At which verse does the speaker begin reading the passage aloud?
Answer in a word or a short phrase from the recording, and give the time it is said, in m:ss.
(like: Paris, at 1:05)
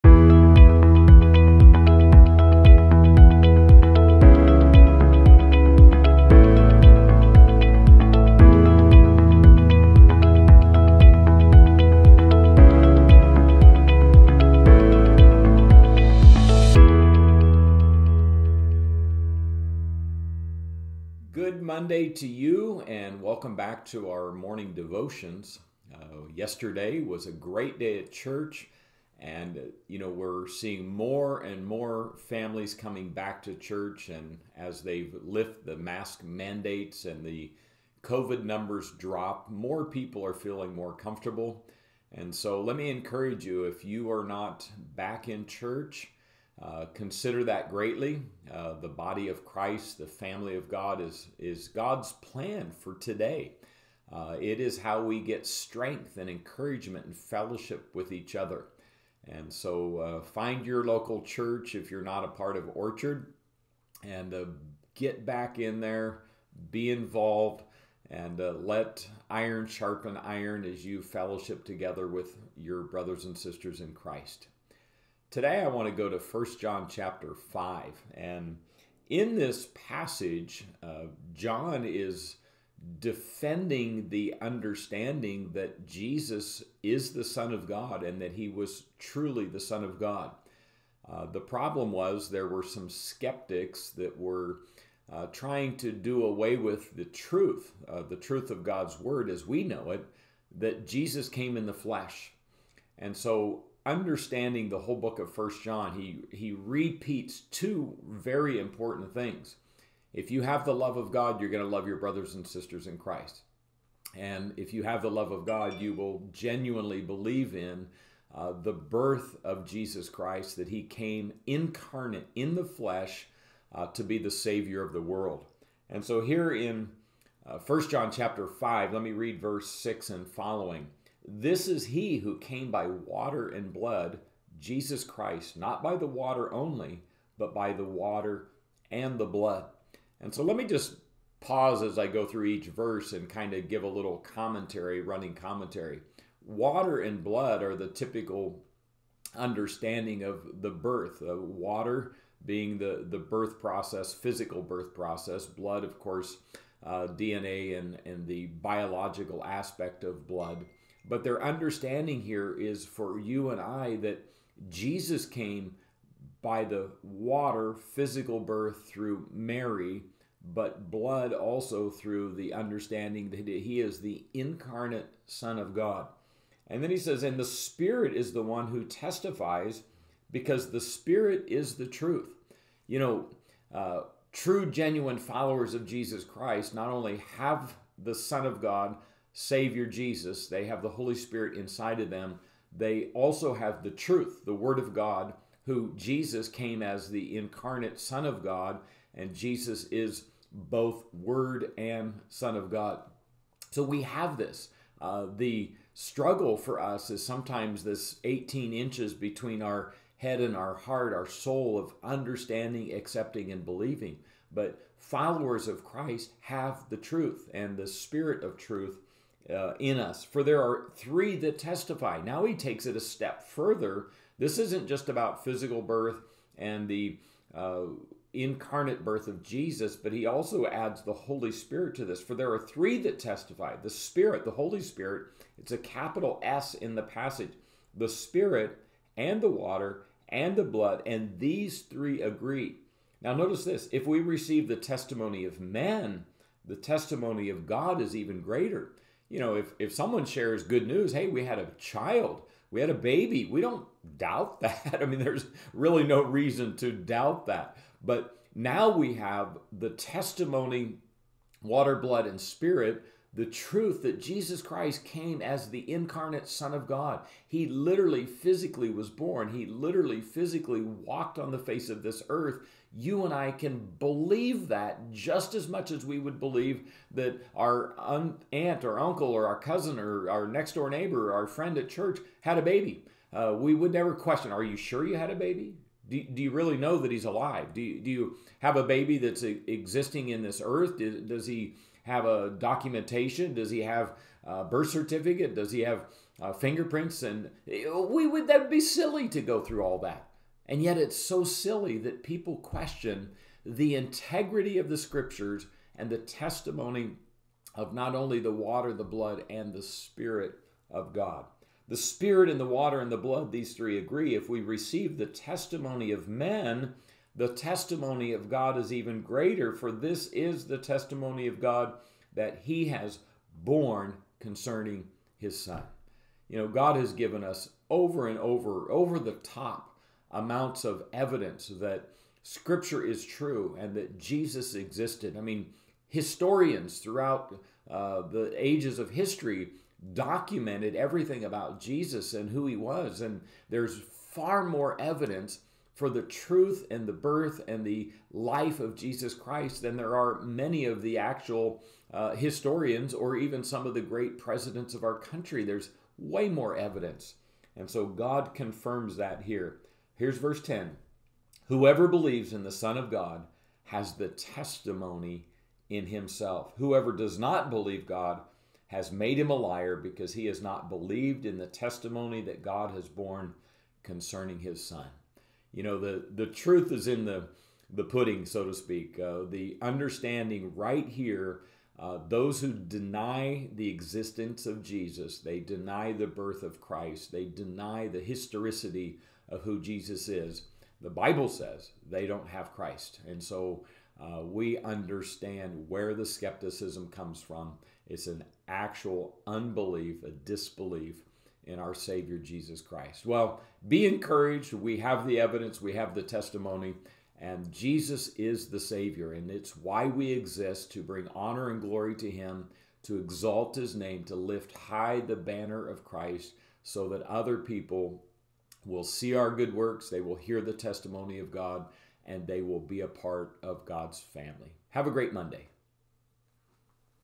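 6, at 2:09.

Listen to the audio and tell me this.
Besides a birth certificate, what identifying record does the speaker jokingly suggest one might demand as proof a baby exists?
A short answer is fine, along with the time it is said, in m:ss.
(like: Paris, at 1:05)
fingerprints, at 4:56.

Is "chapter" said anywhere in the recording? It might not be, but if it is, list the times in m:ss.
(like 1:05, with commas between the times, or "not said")
1:16, 2:08.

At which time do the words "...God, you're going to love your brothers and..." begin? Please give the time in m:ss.
1:51.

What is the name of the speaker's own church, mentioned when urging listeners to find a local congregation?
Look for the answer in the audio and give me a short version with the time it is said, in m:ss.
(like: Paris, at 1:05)
Orchard, at 1:02.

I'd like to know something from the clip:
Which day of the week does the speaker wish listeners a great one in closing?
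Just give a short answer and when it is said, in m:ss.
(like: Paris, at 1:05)
Monday, at 7:05.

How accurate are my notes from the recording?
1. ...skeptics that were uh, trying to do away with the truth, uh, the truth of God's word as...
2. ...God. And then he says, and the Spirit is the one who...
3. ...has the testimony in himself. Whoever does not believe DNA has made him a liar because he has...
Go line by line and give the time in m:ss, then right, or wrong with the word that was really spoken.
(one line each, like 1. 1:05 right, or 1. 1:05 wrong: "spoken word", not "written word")
1. 1:32 right
2. 2:55 right
3. 6:03 wrong: "God", not "DNA".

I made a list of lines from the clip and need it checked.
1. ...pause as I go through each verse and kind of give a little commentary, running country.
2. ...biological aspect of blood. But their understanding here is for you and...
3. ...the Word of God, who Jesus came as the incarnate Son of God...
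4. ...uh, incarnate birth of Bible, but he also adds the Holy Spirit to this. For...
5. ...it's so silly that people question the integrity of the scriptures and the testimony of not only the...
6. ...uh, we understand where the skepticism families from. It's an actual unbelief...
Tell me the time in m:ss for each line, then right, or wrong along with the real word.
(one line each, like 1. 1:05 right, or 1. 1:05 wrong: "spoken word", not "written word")
1. 2:21 wrong: "commentary", not "country"
2. 2:38 right
3. 3:14 right
4. 3:47 wrong: "Jesus", not "Bible"
5. 5:00 right
6. 6:34 wrong: "comes", not "families".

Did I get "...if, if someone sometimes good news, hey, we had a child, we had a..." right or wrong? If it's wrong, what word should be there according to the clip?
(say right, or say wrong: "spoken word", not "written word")
wrong: "shares", not "sometimes".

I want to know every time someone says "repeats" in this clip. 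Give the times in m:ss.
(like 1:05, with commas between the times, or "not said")
1:46.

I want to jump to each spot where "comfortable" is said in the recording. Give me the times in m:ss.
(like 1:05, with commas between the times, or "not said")
0:40.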